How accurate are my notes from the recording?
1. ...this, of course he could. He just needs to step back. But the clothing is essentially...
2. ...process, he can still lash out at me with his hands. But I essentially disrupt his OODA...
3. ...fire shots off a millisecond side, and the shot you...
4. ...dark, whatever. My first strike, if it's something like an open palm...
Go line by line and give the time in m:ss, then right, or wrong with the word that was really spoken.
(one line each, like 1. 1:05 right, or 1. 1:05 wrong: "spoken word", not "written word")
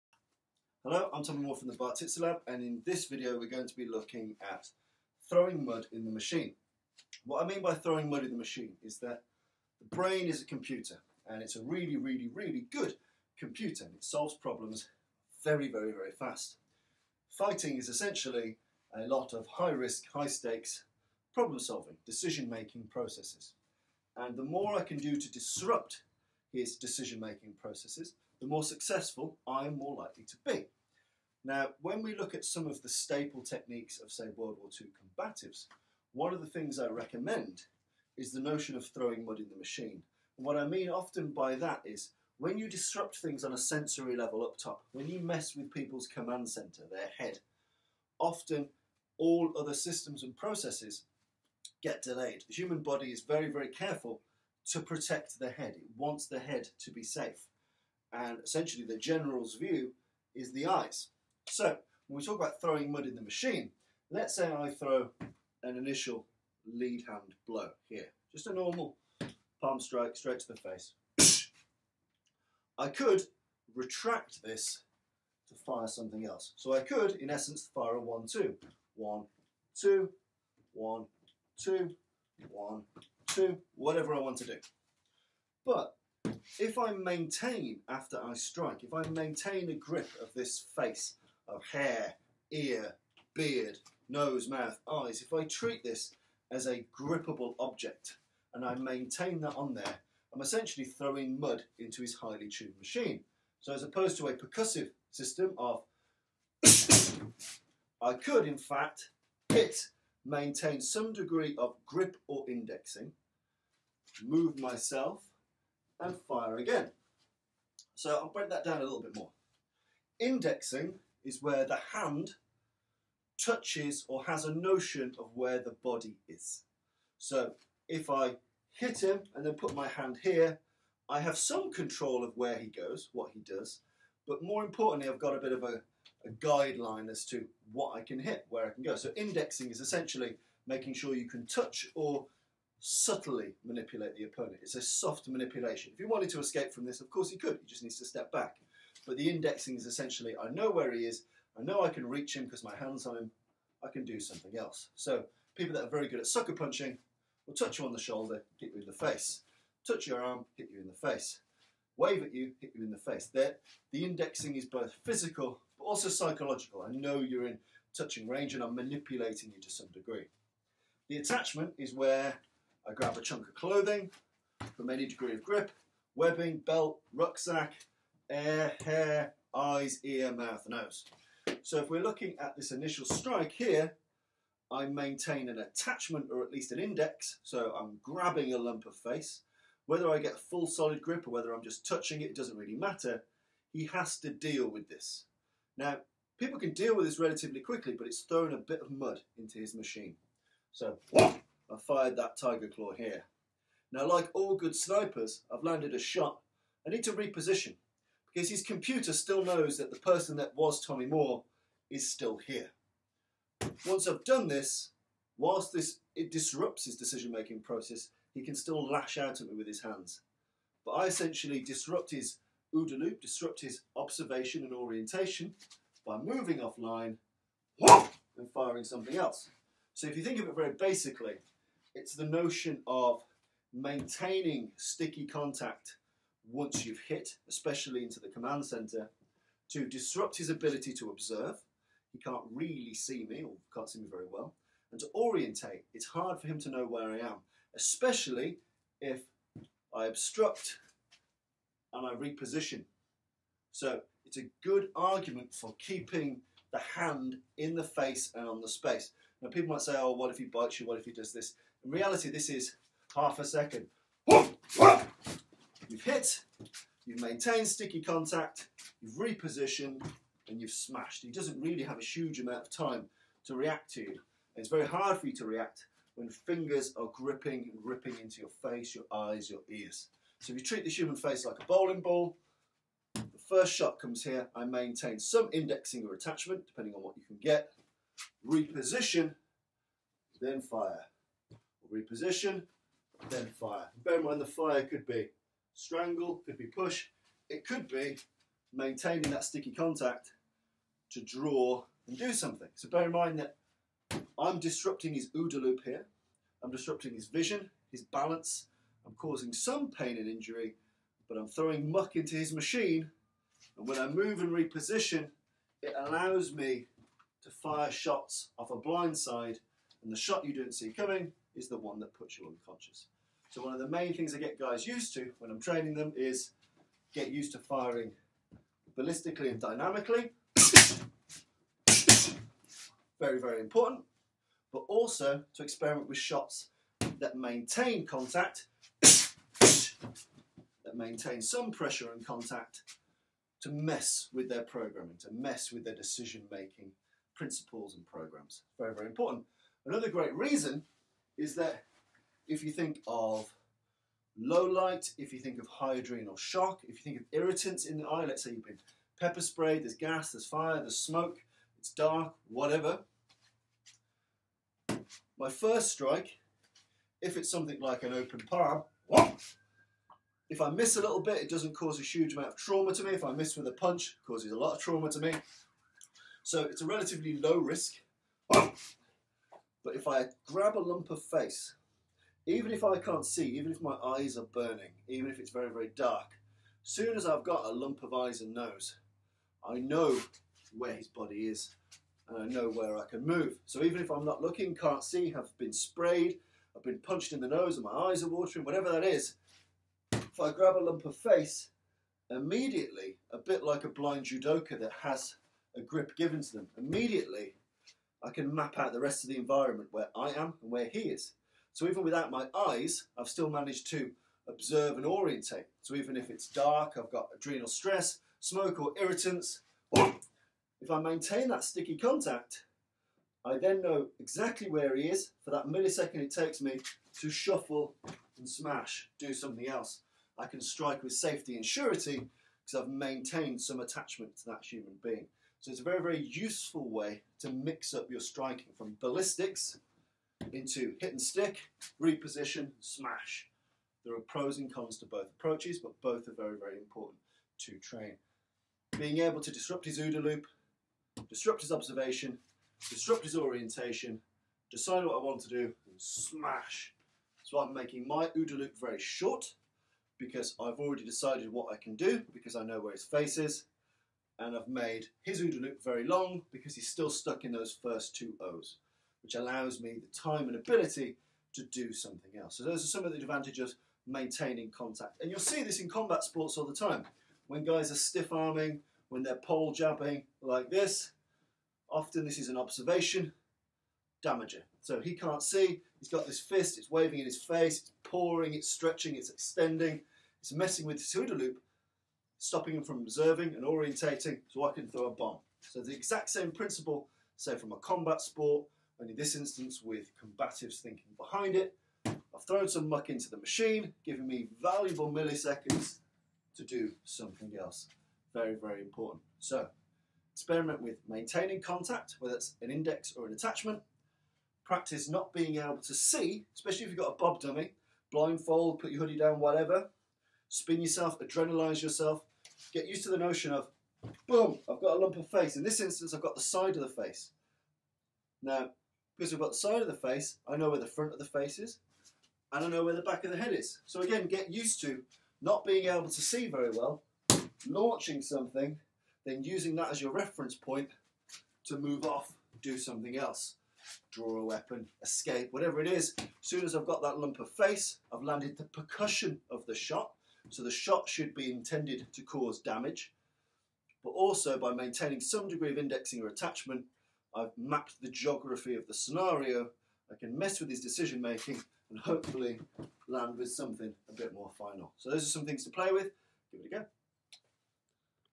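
1. 2:26 wrong: "indexing", not "clothing"
2. 3:37 right
3. 5:17 wrong: "blind", not "millisecond"
4. 6:01 right.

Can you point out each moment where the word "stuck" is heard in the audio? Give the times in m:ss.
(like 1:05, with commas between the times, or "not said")
7:47.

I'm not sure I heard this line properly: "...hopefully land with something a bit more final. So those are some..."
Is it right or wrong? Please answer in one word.
right.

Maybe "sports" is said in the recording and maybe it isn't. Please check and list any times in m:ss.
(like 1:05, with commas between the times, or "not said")
7:56, 8:18.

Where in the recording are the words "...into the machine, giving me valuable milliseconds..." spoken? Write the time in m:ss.
8:23.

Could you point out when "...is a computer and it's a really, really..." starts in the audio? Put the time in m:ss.
0:10.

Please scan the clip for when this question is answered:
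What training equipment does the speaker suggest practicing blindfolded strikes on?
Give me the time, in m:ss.
8:37.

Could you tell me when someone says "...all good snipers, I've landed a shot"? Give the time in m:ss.
3:24.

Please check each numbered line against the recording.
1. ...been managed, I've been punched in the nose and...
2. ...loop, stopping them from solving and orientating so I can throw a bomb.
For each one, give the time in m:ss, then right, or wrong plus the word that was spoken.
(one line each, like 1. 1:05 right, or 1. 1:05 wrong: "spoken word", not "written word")
1. 6:35 wrong: "sprayed", not "managed"
2. 8:11 wrong: "observing", not "solving".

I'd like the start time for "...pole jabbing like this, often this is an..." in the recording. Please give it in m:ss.
7:59.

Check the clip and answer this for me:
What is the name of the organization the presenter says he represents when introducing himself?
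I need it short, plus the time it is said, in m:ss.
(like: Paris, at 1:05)
Bar Lab, at 0:01.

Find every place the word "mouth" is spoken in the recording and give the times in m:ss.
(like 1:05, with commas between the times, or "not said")
1:34, 3:00.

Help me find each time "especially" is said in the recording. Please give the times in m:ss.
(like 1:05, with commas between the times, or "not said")
3:57, 4:07, 8:36.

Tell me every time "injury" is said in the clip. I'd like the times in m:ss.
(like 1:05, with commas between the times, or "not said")
5:10.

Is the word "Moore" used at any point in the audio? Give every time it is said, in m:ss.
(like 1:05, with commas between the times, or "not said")
0:01, 3:31.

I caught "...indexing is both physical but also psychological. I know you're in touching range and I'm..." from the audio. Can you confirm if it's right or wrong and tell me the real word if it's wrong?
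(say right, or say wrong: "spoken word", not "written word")
right.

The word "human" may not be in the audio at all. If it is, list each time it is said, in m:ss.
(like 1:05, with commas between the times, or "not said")
0:52, 4:40, 7:14.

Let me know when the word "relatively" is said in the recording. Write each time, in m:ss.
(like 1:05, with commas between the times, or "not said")
3:17, 6:16.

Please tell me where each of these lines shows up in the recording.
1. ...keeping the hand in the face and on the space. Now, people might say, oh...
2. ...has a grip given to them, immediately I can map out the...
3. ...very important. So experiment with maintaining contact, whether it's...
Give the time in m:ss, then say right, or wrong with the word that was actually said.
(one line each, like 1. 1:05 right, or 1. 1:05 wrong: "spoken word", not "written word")
1. 4:15 right
2. 6:45 right
3. 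8:28 right.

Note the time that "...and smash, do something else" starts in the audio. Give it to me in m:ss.
7:08.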